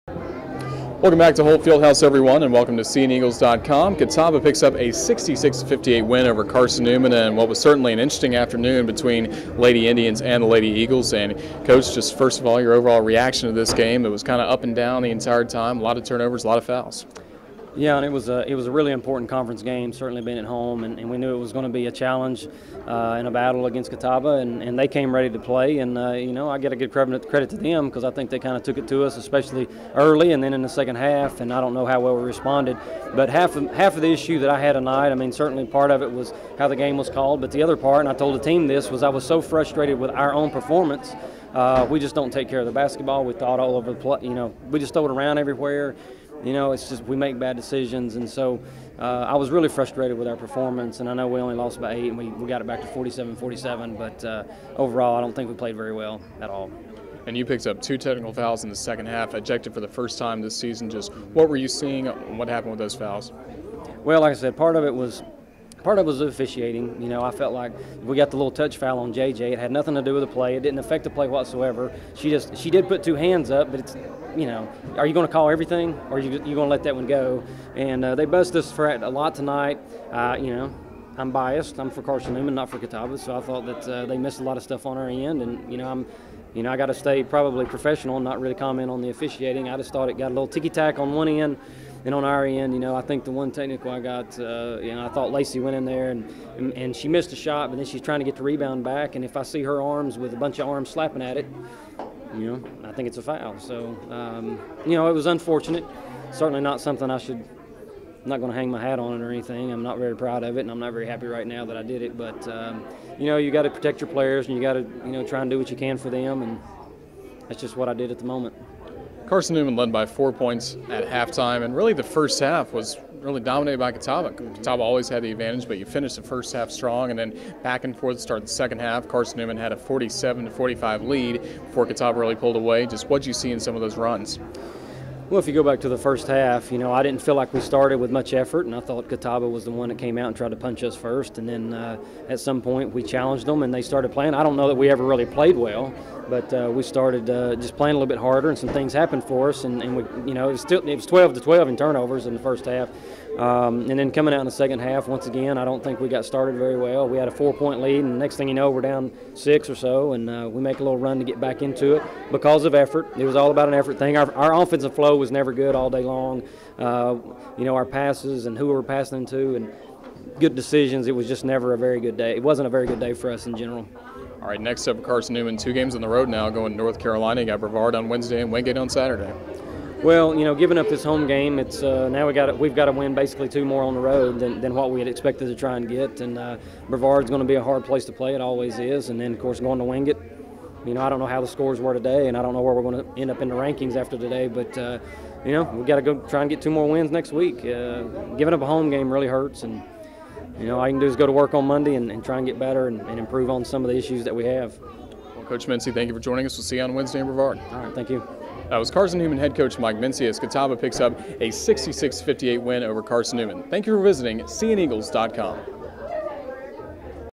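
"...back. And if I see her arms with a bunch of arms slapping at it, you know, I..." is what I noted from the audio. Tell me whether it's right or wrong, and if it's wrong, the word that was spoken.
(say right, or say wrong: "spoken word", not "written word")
right.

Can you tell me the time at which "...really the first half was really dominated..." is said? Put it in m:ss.
2:01.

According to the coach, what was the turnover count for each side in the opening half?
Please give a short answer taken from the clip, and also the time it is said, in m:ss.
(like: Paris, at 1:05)
12 to 12, at 2:31.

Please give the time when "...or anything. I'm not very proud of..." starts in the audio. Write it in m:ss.
1:49.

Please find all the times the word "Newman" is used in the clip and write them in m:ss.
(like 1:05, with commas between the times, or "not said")
0:06, 1:22, 1:59, 2:09, 2:55, 3:29, 3:33.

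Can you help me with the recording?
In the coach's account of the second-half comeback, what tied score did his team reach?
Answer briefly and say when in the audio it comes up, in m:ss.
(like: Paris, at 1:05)
47-47, at 0:52.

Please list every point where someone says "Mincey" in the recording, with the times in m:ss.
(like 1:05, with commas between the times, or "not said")
3:25, 3:29.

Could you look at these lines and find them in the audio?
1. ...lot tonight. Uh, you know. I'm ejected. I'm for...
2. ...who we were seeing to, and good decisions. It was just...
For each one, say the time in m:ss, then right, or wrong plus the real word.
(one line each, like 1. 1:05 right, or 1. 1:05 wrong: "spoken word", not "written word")
1. 1:19 wrong: "biased", not "ejected"
2. 2:48 wrong: "passing", not "seeing".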